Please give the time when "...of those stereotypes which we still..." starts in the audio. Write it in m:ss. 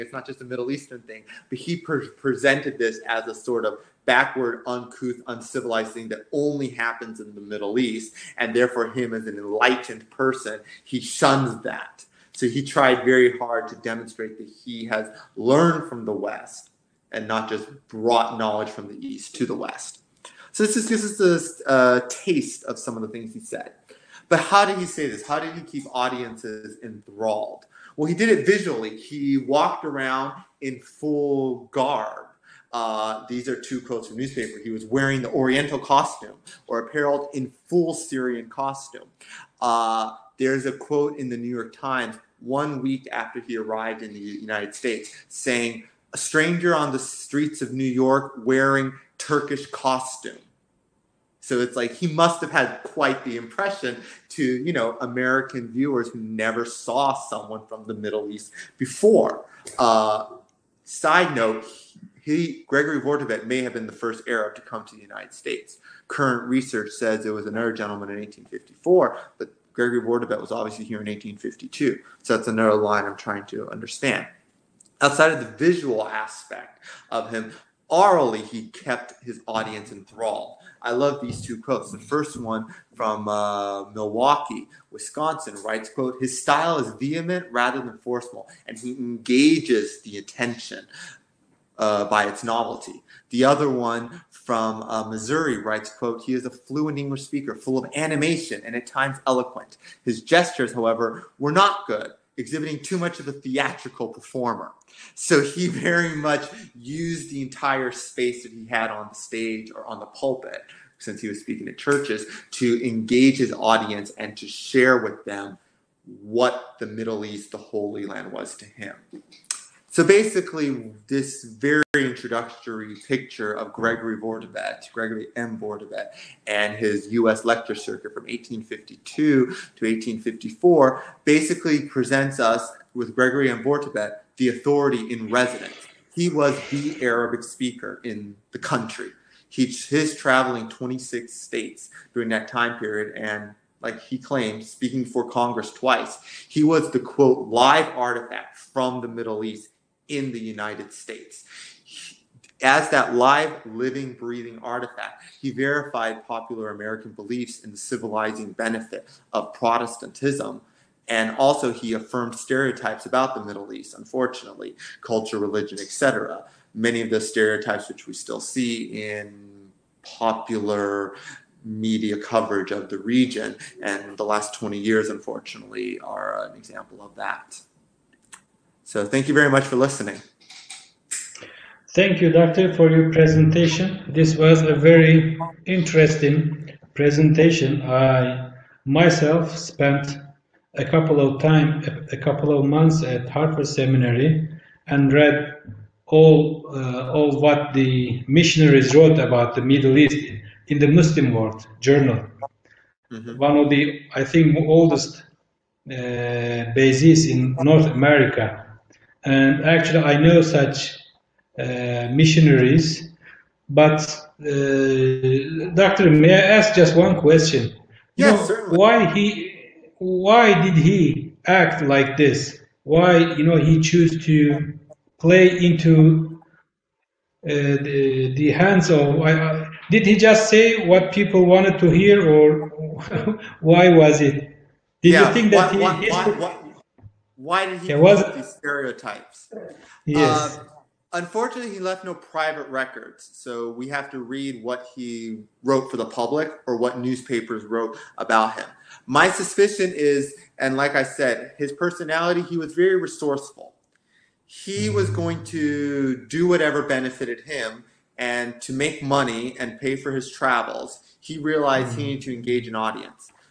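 2:47.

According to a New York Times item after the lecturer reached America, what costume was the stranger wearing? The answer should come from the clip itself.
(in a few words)
Turkish costume.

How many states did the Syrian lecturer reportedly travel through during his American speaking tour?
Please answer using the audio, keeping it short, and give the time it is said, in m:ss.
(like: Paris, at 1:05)
26, at 2:20.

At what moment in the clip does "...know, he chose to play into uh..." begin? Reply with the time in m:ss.
3:43.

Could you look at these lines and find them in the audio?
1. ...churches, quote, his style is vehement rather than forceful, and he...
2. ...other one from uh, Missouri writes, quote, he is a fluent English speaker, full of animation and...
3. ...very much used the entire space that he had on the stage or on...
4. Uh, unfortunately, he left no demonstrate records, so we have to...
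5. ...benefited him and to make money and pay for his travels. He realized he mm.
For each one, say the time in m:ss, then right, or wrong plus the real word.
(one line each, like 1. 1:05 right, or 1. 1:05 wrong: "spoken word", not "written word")
1. 1:25 wrong: "writes", not "churches"
2. 1:33 right
3. 1:45 right
4. 4:00 wrong: "private", not "demonstrate"
5. 4:16 right.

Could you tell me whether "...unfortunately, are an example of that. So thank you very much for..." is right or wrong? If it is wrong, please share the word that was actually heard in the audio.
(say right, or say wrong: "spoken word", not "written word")
right.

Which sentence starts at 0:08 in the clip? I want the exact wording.
And therefore, him as an enlightened person, he shuns that.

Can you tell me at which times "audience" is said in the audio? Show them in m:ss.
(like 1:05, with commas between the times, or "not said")
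0:25, 1:19, 1:53, 4:22.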